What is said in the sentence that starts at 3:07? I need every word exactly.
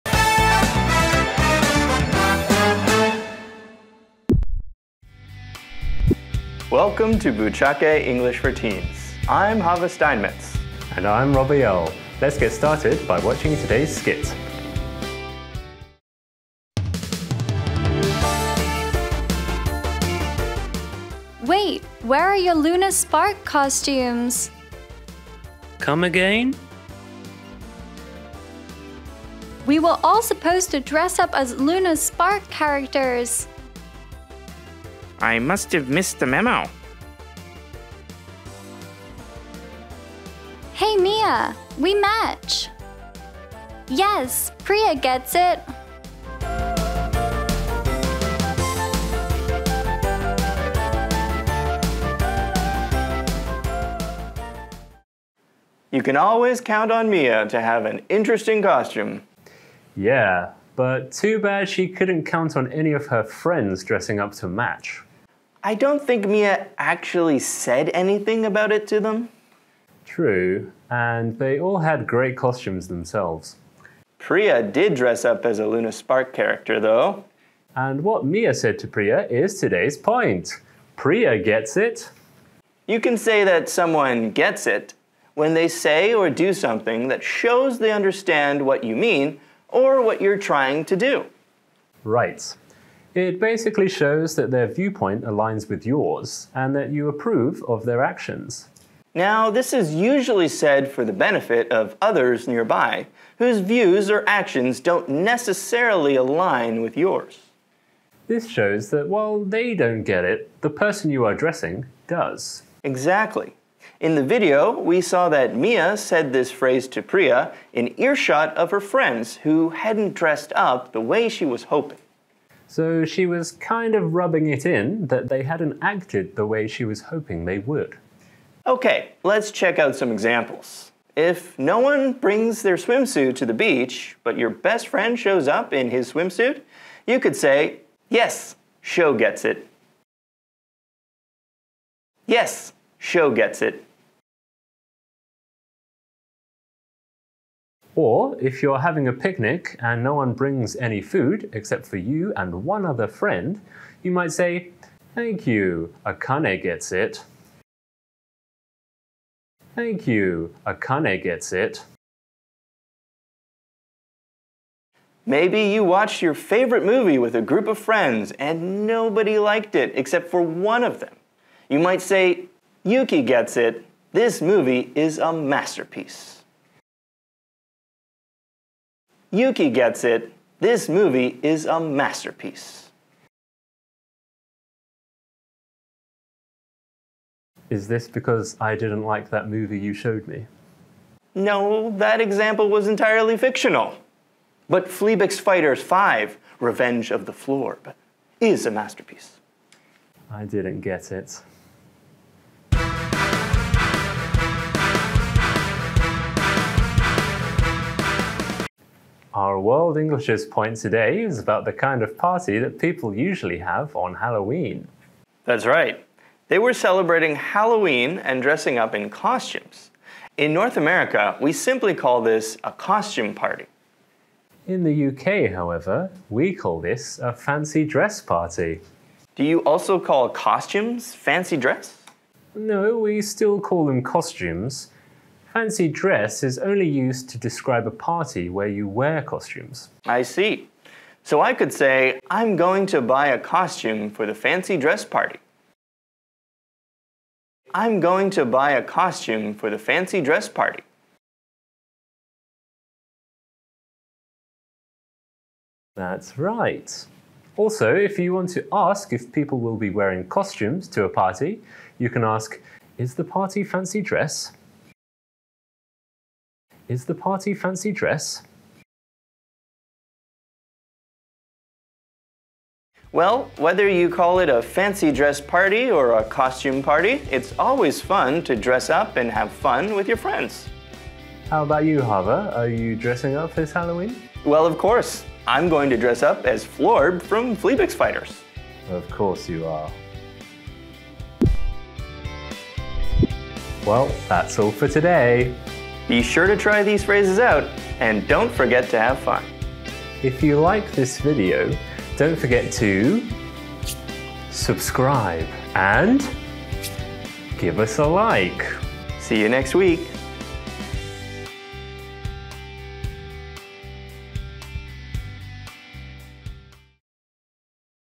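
Is this because I didn't like that movie you showed me?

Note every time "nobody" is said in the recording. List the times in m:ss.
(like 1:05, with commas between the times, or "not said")
2:48.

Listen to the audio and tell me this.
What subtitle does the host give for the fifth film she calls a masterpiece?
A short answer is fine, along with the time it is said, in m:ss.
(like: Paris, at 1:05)
Revenge of the Florb, at 3:16.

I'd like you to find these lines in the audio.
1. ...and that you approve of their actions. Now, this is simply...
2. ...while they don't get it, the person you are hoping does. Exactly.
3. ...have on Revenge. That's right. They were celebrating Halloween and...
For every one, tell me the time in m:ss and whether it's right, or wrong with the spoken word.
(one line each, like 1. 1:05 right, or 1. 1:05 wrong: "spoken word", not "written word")
1. 1:36 wrong: "usually", not "simply"
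2. 1:49 wrong: "addressing", not "hoping"
3. 3:33 wrong: "Halloween", not "Revenge".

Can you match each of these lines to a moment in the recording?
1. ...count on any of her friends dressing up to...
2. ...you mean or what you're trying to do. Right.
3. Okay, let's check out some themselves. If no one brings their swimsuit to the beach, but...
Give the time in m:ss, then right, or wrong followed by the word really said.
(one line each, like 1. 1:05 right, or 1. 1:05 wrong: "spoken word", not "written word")
1. 1:02 right
2. 1:28 right
3. 2:08 wrong: "examples", not "themselves".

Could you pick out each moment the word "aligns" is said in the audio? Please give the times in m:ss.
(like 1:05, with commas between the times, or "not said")
1:35, 1:46.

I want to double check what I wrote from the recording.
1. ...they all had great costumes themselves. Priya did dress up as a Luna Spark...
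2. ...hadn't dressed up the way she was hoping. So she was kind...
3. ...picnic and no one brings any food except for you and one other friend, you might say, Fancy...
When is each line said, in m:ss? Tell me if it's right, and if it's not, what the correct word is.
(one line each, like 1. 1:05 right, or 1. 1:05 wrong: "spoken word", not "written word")
1. 1:11 right
2. 1:59 right
3. 2:29 wrong: "Thank", not "Fancy".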